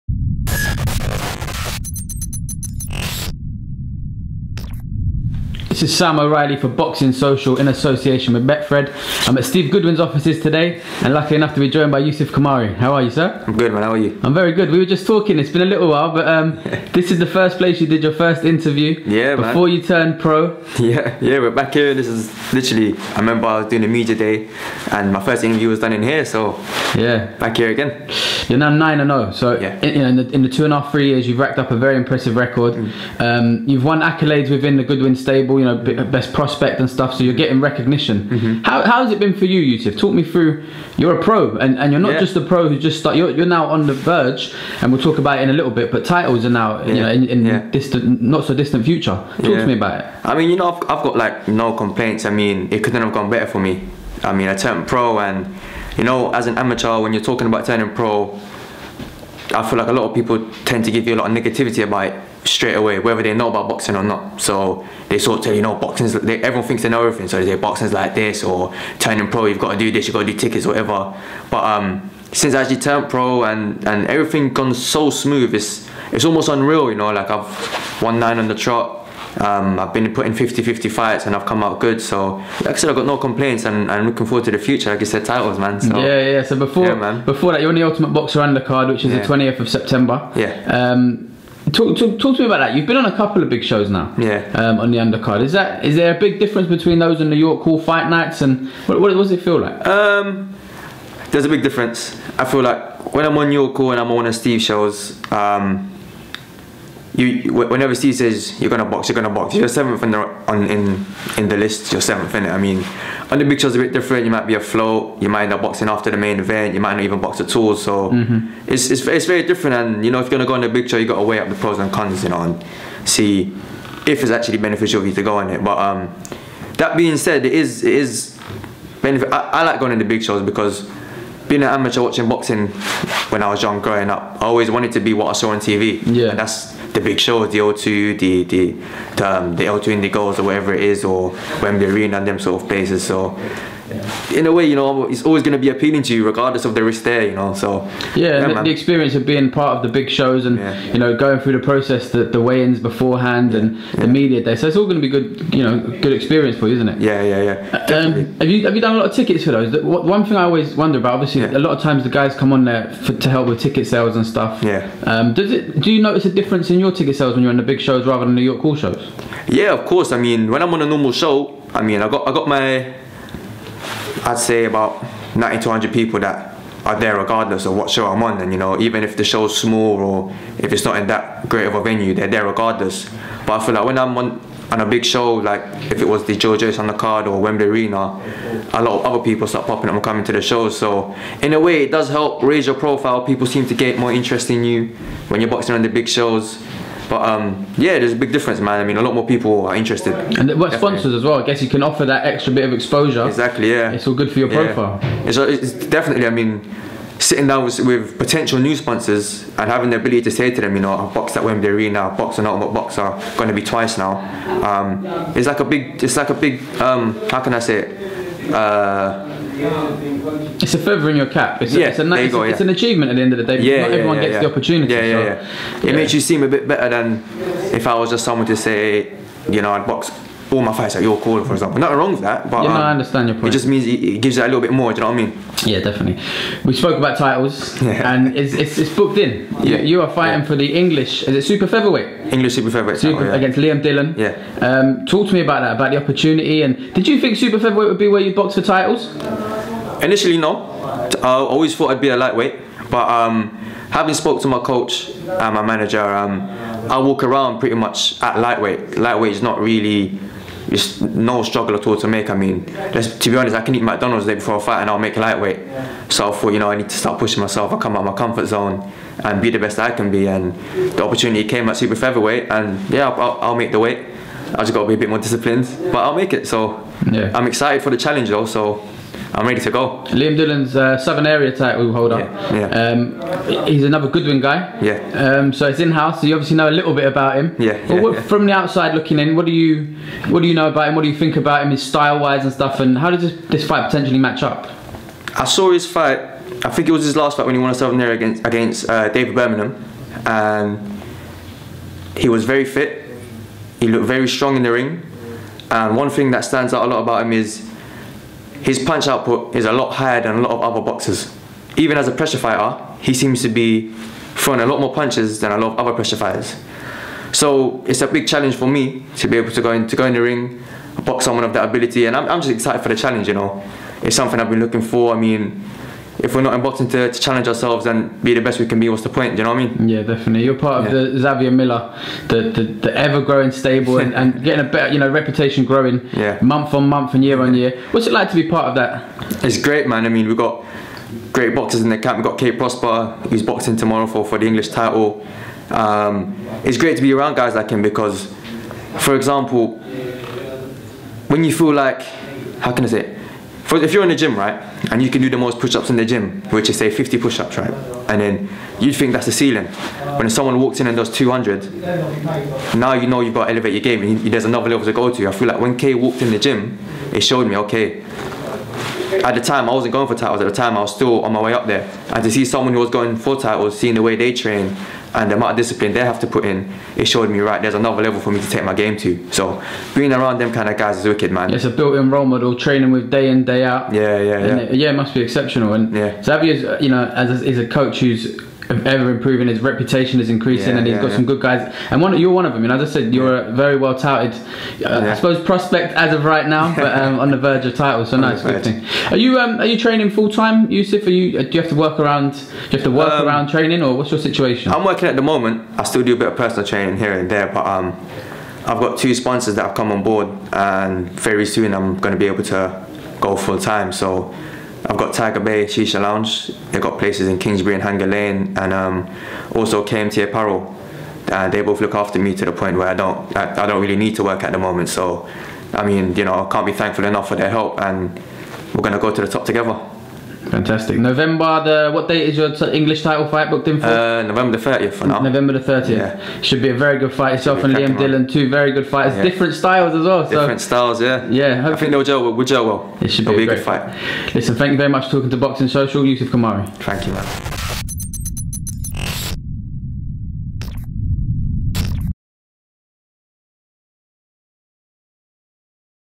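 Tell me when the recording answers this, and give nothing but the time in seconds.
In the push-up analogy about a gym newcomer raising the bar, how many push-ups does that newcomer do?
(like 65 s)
361 s.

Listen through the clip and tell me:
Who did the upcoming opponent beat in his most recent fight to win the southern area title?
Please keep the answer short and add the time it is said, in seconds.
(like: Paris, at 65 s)
David Birmingham, at 299 s.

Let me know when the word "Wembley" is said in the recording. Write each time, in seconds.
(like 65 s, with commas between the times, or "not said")
141 s, 187 s, 211 s.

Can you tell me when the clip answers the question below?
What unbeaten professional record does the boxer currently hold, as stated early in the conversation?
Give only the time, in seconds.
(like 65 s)
28 s.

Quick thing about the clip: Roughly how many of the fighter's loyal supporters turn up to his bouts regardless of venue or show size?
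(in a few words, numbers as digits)
90 to 100.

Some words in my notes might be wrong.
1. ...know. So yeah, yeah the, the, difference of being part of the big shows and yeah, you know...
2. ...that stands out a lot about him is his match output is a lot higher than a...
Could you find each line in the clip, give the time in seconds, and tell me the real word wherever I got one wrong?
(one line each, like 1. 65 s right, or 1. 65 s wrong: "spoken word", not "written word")
1. 147 s wrong: "experience", not "difference"
2. 306 s wrong: "punch", not "match".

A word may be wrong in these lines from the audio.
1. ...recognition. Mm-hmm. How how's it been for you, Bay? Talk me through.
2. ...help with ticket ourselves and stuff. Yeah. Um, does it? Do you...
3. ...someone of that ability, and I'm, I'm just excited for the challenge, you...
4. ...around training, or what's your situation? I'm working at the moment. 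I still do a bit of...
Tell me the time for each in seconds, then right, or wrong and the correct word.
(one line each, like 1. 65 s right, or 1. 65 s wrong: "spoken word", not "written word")
1. 37 s wrong: "Youssef", not "Bay"
2. 163 s wrong: "sales", not "ourselves"
3. 321 s right
4. 403 s right.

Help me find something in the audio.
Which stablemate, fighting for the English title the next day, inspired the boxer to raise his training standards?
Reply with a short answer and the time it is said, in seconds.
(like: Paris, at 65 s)
Kay Prospere, at 342 s.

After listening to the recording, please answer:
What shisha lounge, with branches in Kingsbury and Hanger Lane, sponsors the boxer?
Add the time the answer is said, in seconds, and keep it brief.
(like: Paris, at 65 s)
Tiger Bay Shisha Lounge, at 415 s.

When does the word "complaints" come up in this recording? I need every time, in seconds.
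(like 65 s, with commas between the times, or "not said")
51 s, 83 s.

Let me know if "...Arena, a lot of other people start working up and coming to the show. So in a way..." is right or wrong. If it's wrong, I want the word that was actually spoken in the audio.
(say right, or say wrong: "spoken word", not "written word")
wrong: "popping", not "working".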